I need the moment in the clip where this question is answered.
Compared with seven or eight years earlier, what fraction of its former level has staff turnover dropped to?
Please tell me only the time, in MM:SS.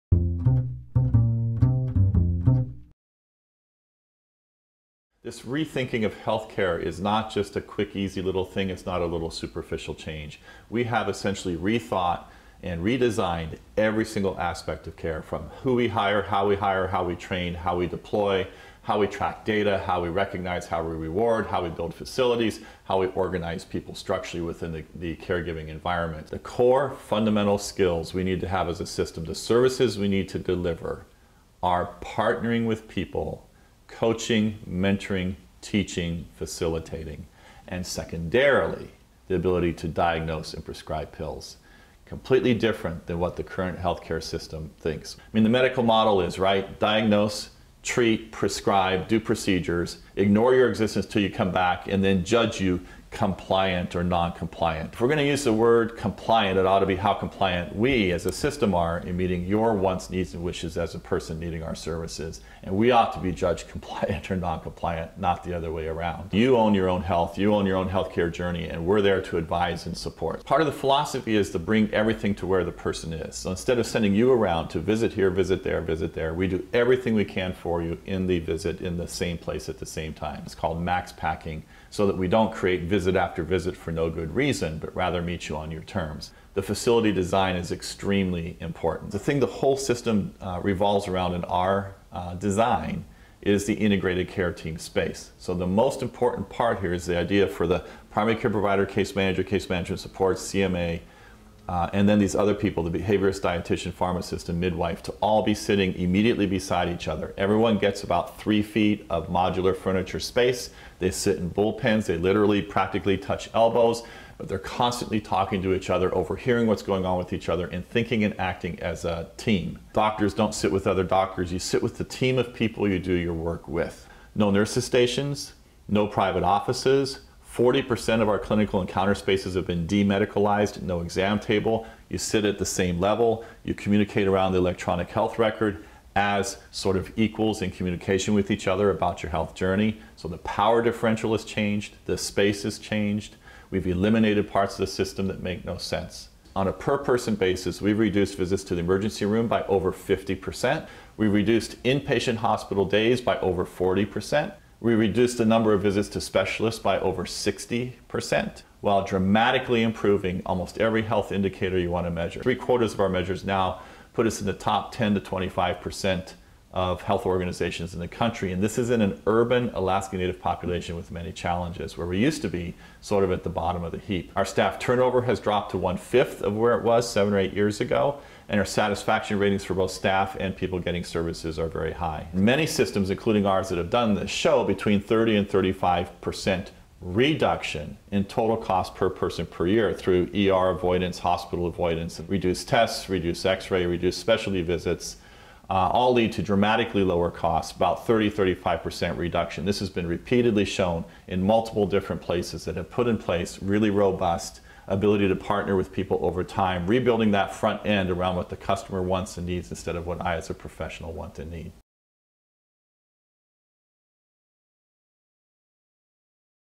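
02:55.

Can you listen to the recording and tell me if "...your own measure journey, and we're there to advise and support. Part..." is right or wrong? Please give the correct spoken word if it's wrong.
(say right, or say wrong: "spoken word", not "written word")
wrong: "healthcare", not "measure".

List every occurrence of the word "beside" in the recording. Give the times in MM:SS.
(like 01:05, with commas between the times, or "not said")
01:46.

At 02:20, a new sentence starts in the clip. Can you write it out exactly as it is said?
So the power differential has changed, the space has changed.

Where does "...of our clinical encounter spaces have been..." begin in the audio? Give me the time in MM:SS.
02:08.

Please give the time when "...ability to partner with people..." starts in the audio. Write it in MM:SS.
03:24.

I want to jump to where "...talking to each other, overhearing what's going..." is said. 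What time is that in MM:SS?
01:55.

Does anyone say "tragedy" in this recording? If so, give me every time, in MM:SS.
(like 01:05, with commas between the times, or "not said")
not said.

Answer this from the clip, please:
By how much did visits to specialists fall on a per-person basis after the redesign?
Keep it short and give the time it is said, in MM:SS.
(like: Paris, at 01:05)
over 60%, at 02:36.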